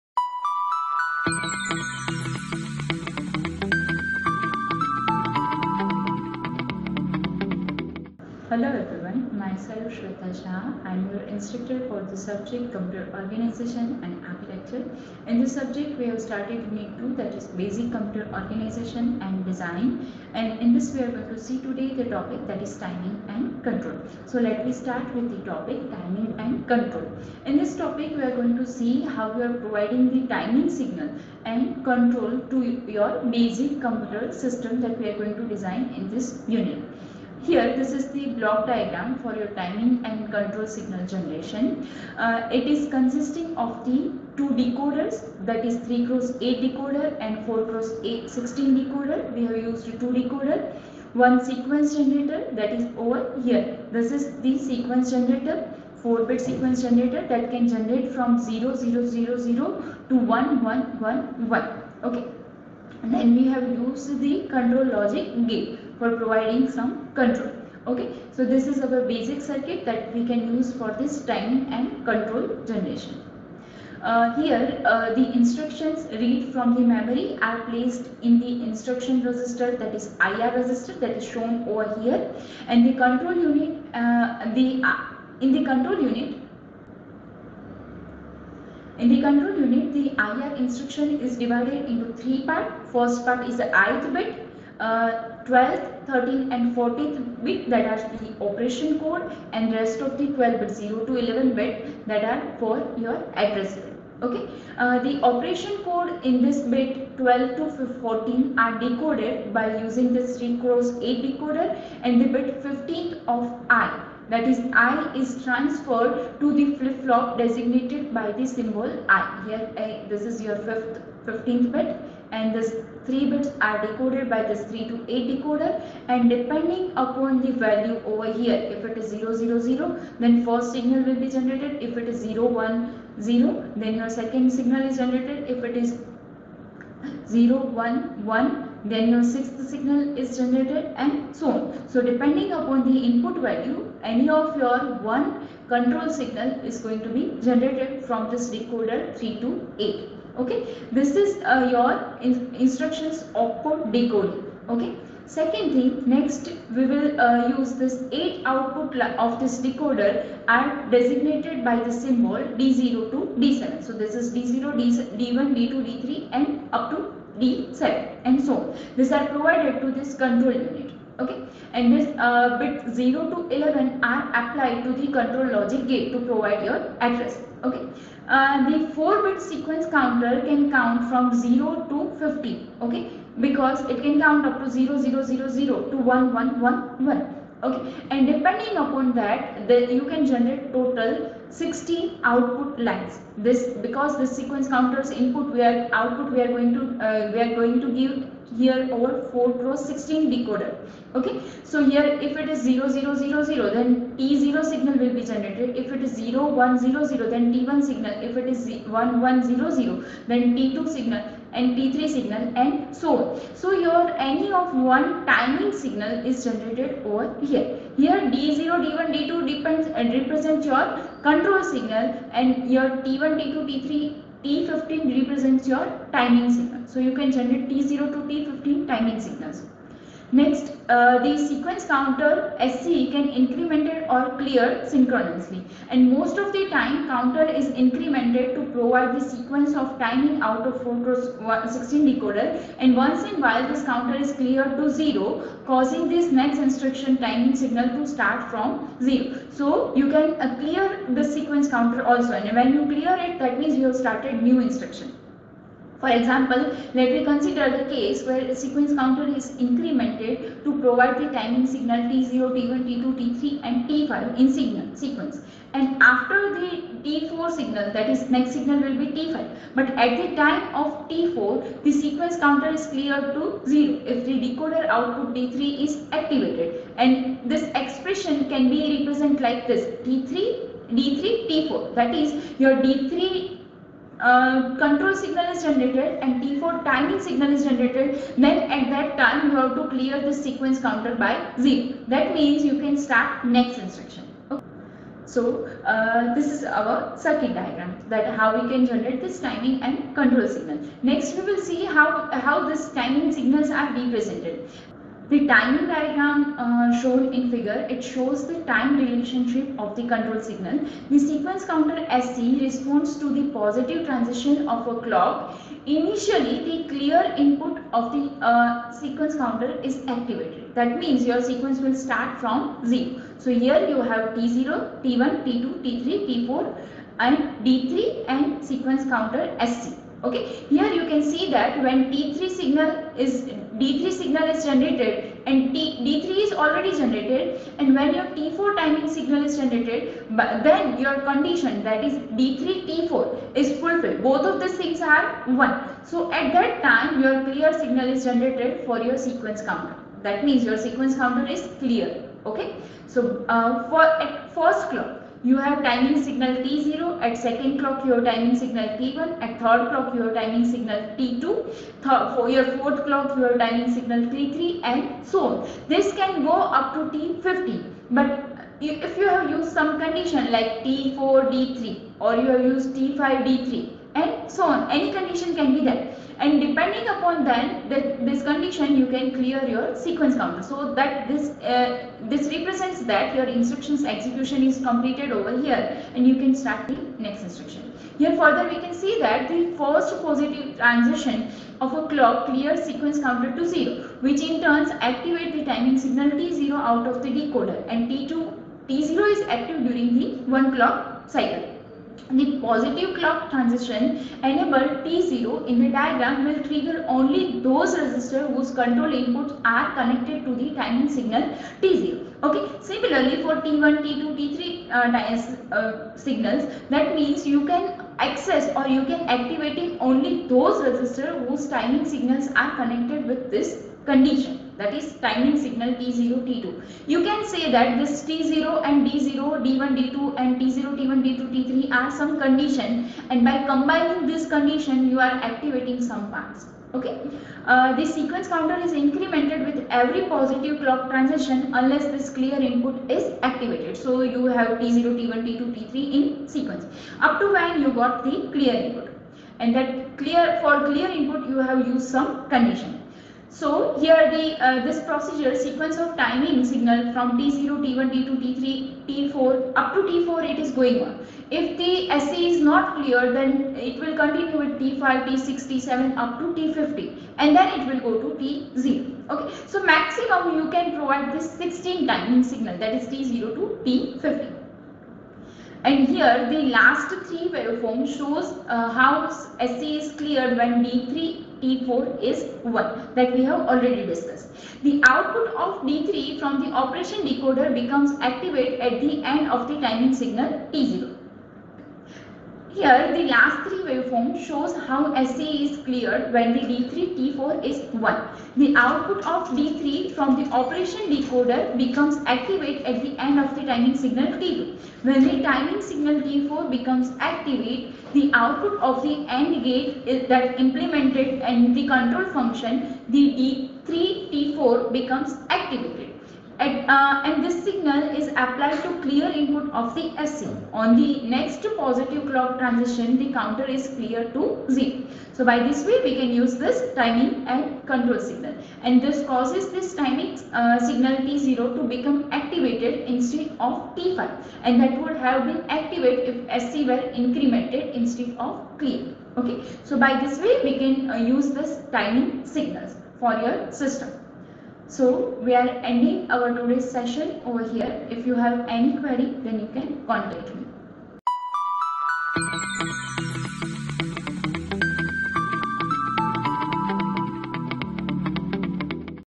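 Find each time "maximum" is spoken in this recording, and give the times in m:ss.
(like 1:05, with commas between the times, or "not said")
7:49.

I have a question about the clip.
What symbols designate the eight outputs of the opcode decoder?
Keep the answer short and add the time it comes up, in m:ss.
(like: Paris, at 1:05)
D0 to D7, at 2:42.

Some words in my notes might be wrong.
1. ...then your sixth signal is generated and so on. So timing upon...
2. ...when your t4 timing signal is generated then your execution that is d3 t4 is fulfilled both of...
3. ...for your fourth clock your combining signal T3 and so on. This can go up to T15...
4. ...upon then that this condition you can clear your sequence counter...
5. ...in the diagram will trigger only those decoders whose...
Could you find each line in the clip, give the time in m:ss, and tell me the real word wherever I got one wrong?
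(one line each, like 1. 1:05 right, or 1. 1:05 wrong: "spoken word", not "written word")
1. 2:18 wrong: "depending", not "timing"
2. 5:37 wrong: "condition", not "execution"
3. 6:02 wrong: "timing", not "combining"
4. 6:17 right
5. 6:45 wrong: "registers", not "decoders".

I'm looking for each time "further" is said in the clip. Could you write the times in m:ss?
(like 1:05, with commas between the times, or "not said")
6:28.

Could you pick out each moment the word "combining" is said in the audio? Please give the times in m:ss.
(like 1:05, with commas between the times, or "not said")
7:13.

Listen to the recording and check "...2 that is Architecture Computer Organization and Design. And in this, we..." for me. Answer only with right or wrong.
wrong.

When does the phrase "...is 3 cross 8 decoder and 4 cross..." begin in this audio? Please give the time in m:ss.
0:45.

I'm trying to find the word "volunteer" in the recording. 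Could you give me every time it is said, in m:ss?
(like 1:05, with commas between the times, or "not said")
not said.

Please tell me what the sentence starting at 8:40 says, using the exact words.
On the next positive clock transition, the counter is clear to 0.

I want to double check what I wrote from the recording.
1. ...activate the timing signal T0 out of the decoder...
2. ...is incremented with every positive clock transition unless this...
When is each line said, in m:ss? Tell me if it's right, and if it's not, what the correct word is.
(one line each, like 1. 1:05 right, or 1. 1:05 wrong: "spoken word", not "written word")
1. 6:35 right
2. 7:18 right.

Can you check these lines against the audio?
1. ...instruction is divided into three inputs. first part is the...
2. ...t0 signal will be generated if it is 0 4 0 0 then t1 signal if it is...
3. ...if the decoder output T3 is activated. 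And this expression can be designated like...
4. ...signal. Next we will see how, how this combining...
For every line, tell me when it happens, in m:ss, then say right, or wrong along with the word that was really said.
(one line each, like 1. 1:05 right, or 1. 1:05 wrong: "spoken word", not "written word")
1. 1:30 wrong: "parts", not "inputs"
2. 3:24 wrong: "1", not "4"
3. 4:34 wrong: "represented", not "designated"
4. 5:00 wrong: "timing", not "combining".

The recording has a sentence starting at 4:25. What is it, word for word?
And after the T4 signal, that is next signal will be T5.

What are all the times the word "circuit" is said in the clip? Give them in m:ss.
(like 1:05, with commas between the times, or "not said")
1:09, 4:57.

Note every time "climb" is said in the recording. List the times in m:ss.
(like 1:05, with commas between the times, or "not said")
not said.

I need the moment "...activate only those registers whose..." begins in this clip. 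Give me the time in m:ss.
6:59.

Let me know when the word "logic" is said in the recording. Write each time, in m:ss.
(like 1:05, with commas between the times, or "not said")
1:04, 2:55.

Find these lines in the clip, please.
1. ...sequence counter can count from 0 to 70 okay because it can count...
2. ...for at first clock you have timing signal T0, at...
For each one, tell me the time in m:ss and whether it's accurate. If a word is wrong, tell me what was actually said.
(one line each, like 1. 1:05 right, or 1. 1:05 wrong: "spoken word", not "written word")
1. 2:59 wrong: "50", not "70"
2. 5:53 right.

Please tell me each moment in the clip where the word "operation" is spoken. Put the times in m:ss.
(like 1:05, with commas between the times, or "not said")
1:38, 1:45, 8:06, 8:20.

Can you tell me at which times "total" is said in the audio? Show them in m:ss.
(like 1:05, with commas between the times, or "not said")
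3:10.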